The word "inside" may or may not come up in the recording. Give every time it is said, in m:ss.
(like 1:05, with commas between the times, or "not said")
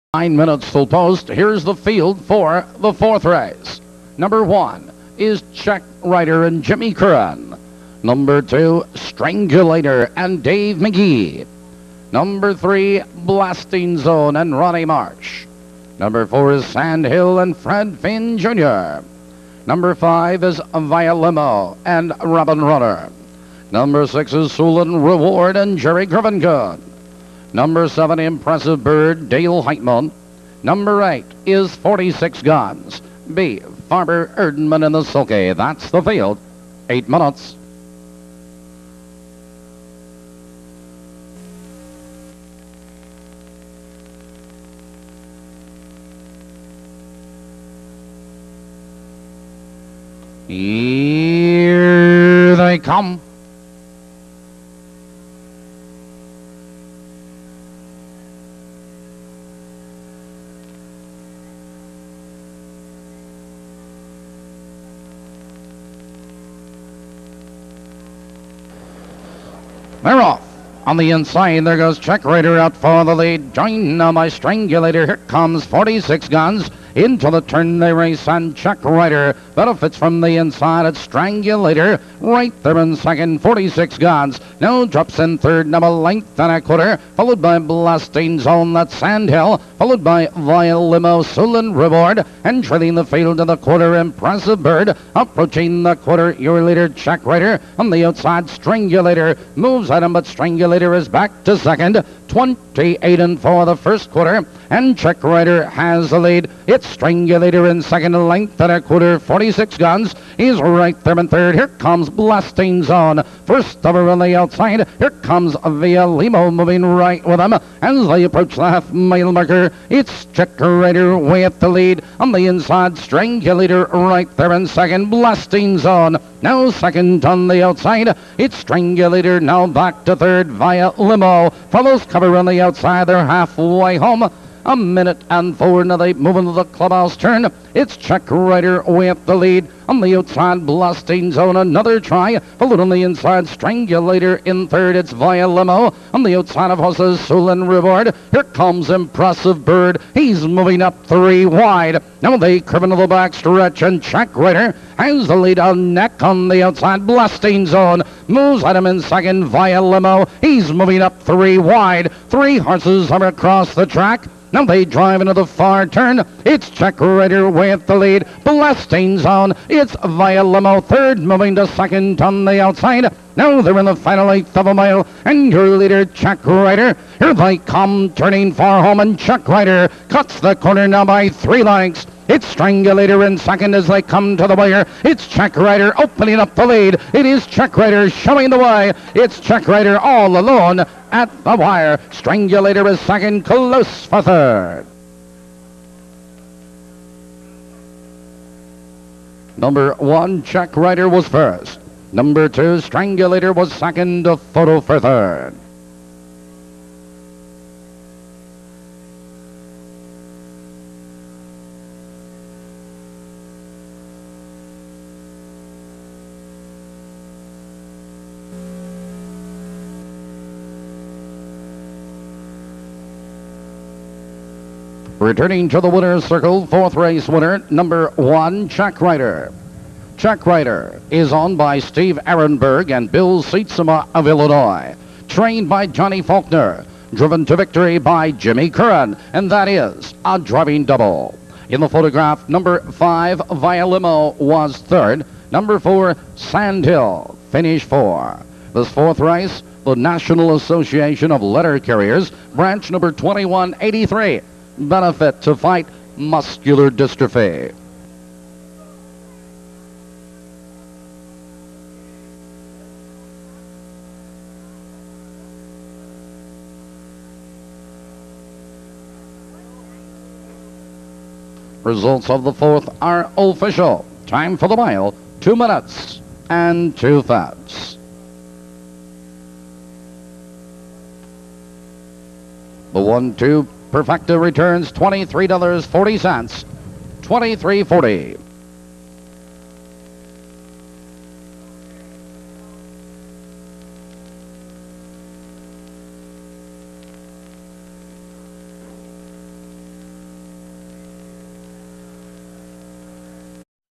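1:11, 1:20, 2:02, 2:23.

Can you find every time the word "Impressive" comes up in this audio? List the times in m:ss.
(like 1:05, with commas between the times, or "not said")
0:28, 1:33, 2:28.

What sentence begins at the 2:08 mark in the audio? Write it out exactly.
It's Strangulator now back to third via Limo.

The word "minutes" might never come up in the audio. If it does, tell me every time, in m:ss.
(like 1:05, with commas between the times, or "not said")
0:00, 0:37, 2:14, 4:35.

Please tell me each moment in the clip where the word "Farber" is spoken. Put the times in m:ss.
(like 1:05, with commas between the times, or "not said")
0:33.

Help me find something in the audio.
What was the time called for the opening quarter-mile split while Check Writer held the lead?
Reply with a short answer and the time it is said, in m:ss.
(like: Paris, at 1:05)
28 and 4, at 1:42.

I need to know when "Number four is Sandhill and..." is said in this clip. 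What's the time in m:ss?
0:15.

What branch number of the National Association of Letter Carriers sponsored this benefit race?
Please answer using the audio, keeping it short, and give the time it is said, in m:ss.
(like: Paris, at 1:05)
2183, at 4:13.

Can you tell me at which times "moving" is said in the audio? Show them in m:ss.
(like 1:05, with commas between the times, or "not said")
1:56, 2:30, 2:40, 2:51.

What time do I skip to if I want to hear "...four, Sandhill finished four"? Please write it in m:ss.
4:05.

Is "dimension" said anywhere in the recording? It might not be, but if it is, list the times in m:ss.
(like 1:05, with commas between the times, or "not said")
not said.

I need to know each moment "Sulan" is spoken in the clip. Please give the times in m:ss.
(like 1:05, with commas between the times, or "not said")
0:24, 1:31.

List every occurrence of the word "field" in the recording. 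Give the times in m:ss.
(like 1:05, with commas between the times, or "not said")
0:01, 0:36, 1:33.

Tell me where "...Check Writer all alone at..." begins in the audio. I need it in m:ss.
3:09.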